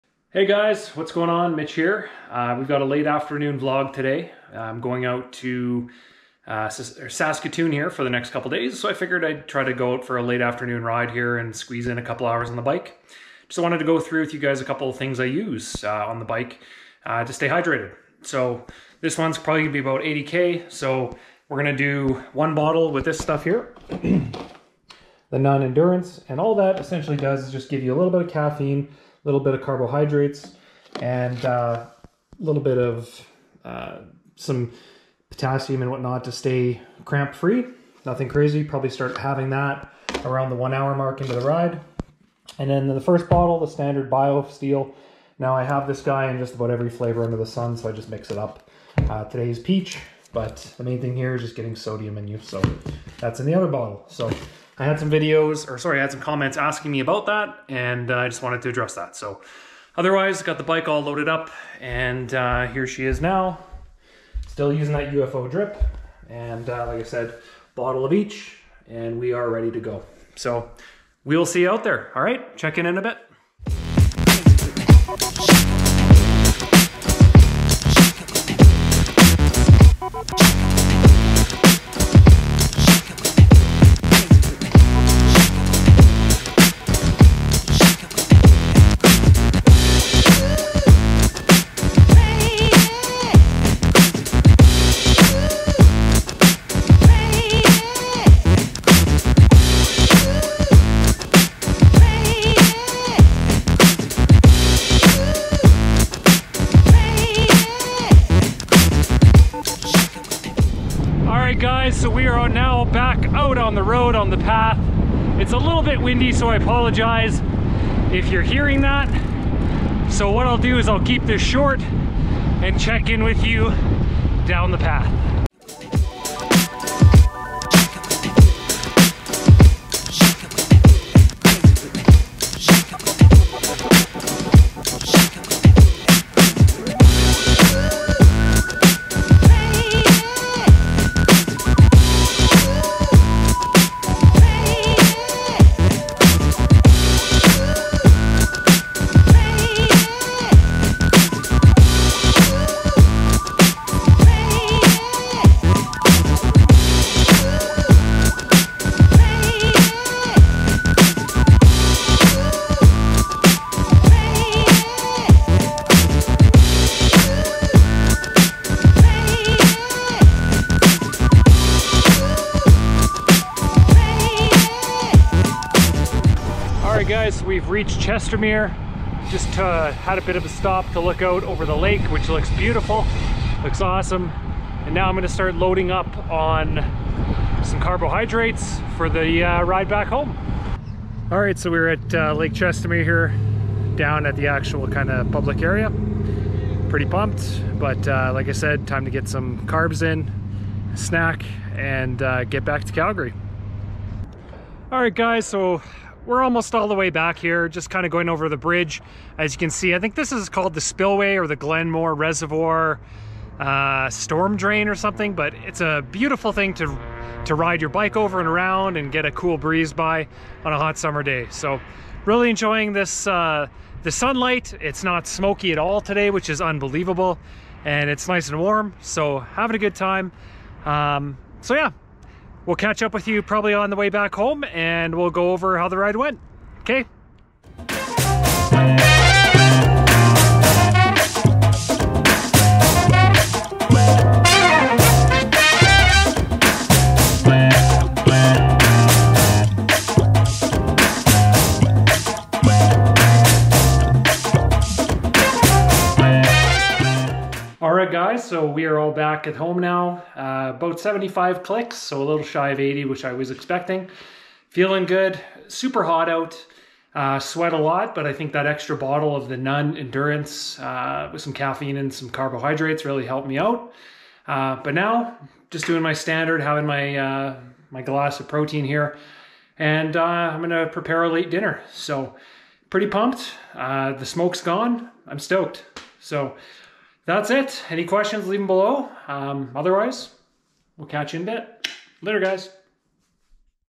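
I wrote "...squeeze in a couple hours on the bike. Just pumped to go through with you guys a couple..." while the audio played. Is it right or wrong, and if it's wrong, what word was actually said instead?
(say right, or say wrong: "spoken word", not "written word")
wrong: "wanted", not "pumped".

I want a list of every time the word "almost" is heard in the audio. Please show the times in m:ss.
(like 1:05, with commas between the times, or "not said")
3:26.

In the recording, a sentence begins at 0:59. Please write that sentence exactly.
So otherwise, got the bike all loaded up, and uh, here she is now.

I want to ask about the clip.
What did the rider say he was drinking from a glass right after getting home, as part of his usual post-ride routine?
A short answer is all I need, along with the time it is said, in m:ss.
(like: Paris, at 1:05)
Protein, at 4:38.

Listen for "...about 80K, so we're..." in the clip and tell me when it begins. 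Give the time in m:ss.
0:19.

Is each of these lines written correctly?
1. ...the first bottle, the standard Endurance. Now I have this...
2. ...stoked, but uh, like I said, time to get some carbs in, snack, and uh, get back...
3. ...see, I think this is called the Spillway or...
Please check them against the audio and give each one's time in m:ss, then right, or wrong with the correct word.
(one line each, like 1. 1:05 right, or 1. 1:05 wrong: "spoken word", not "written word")
1. 0:42 wrong: "BioSteel", not "Endurance"
2. 3:17 wrong: "pumped", not "stoked"
3. 3:29 right.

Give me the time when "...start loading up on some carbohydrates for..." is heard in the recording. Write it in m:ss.
3:05.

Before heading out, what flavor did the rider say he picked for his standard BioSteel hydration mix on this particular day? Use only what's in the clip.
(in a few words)
Peach.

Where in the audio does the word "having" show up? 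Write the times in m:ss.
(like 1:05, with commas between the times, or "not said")
0:39, 3:49, 4:36.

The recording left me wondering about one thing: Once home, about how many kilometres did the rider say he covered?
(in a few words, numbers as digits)
75.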